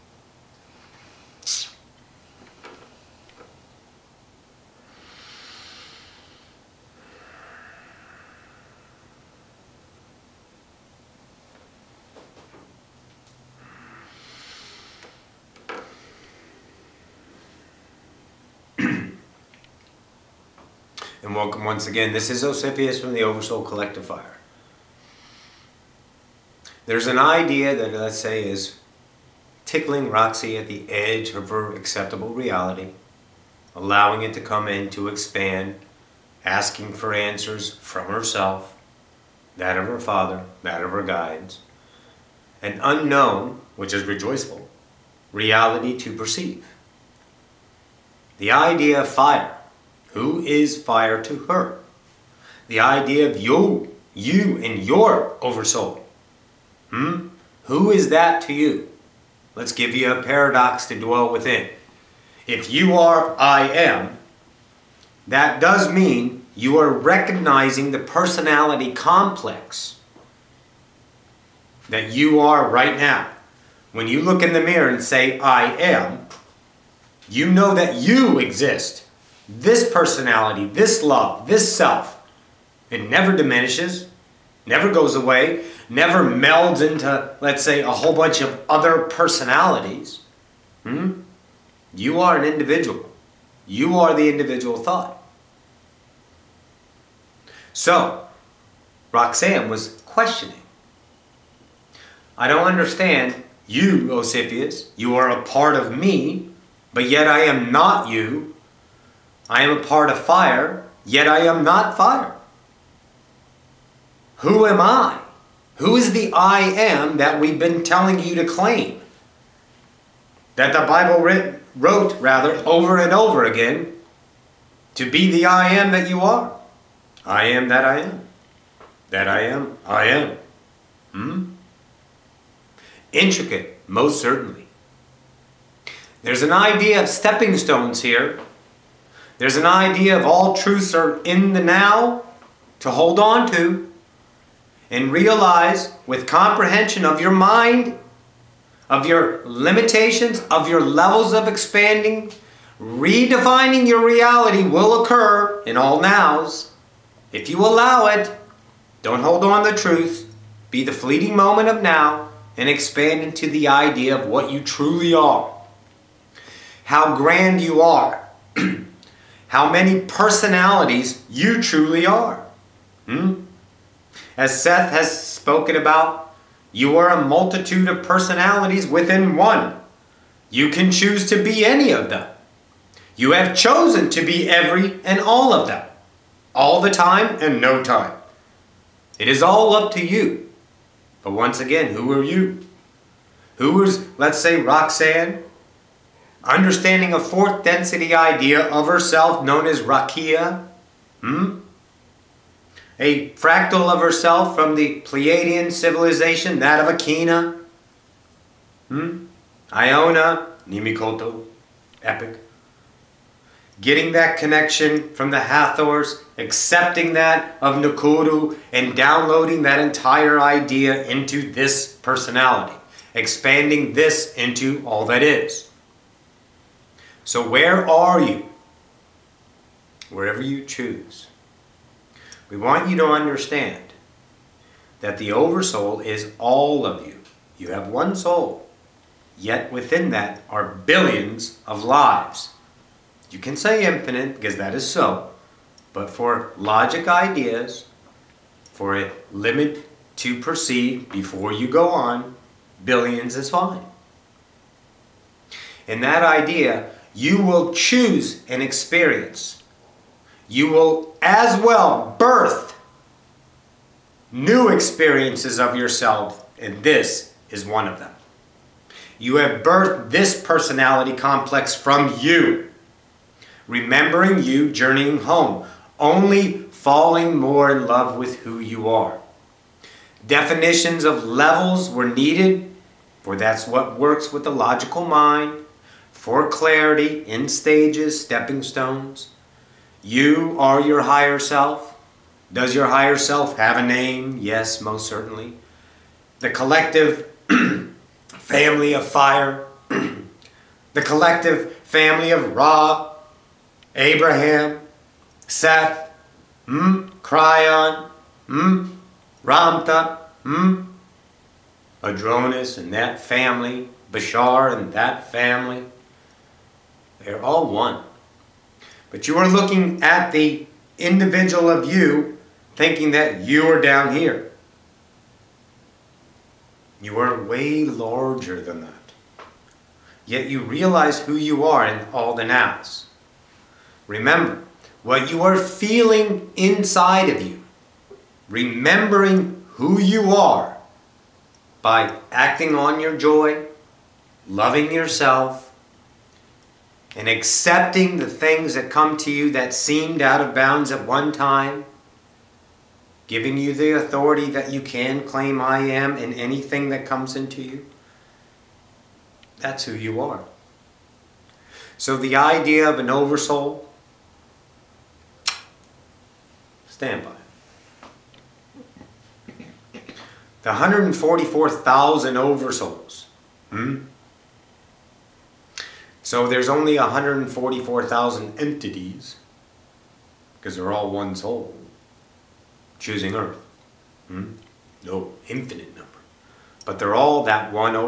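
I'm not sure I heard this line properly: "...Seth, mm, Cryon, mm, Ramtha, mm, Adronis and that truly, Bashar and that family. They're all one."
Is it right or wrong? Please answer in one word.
wrong.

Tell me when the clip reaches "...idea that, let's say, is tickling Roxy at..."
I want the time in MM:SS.
00:27.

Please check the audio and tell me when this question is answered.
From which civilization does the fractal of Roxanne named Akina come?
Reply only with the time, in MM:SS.
03:25.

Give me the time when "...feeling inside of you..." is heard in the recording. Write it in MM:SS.
05:35.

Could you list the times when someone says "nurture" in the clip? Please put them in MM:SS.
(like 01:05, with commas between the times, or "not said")
not said.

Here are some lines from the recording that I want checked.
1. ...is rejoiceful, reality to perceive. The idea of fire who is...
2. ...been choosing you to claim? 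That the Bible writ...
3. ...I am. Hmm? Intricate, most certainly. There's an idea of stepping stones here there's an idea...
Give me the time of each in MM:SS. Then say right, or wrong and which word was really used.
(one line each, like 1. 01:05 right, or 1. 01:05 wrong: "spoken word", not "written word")
1. 00:43 right
2. 01:57 wrong: "telling", not "choosing"
3. 02:09 right.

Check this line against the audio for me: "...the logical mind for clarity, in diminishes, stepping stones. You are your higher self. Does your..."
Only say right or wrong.
wrong.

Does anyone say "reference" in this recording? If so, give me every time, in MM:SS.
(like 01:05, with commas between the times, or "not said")
not said.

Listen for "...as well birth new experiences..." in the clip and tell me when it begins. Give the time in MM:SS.
04:21.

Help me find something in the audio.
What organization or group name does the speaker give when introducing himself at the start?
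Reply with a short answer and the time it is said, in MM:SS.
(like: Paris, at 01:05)
Oversoul Collectifier, at 00:23.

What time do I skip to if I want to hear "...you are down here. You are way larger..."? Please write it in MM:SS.
05:23.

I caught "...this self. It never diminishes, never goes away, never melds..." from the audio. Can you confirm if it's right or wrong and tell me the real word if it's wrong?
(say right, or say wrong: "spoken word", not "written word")
right.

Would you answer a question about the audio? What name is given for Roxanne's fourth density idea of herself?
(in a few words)
Rakia.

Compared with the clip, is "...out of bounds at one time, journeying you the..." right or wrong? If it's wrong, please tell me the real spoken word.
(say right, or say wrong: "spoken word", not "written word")
wrong: "giving", not "journeying".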